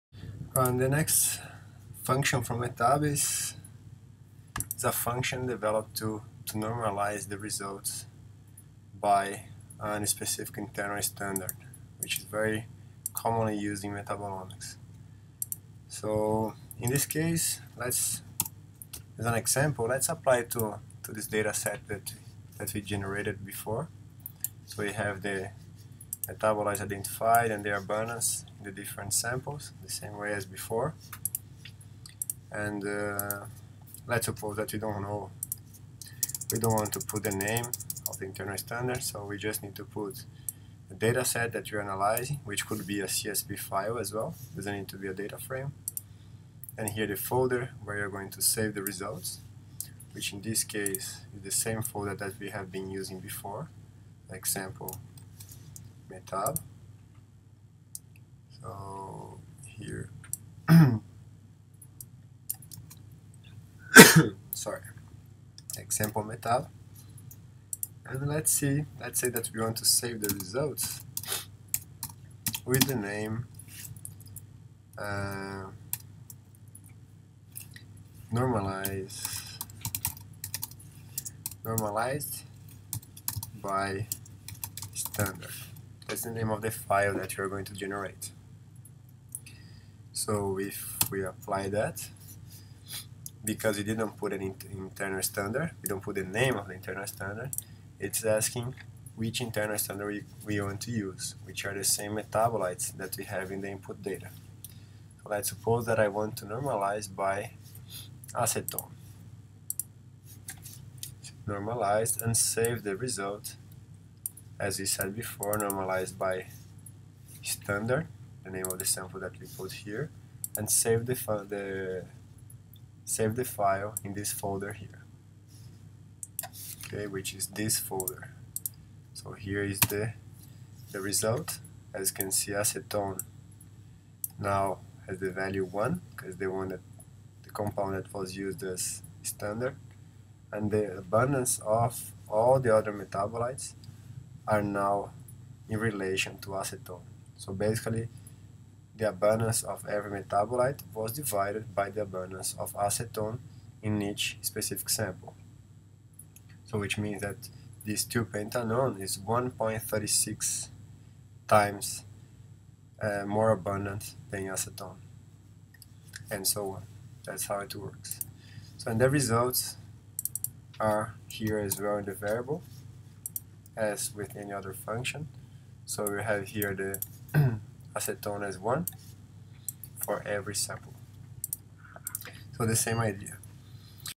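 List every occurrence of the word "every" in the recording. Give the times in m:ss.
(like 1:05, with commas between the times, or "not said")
2:29, 3:00.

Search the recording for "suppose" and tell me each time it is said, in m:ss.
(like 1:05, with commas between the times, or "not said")
0:34, 1:45.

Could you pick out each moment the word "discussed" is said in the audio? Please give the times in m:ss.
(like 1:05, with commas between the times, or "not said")
not said.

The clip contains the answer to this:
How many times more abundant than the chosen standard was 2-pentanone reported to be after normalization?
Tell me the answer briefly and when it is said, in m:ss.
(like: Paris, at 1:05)
1.36, at 2:39.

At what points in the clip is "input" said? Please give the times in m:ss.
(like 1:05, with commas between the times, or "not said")
1:43.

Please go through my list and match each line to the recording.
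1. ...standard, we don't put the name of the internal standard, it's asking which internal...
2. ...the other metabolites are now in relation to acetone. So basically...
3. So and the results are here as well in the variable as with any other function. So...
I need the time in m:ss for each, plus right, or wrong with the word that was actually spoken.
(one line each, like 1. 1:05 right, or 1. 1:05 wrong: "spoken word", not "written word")
1. 1:35 right
2. 2:22 right
3. 2:48 right.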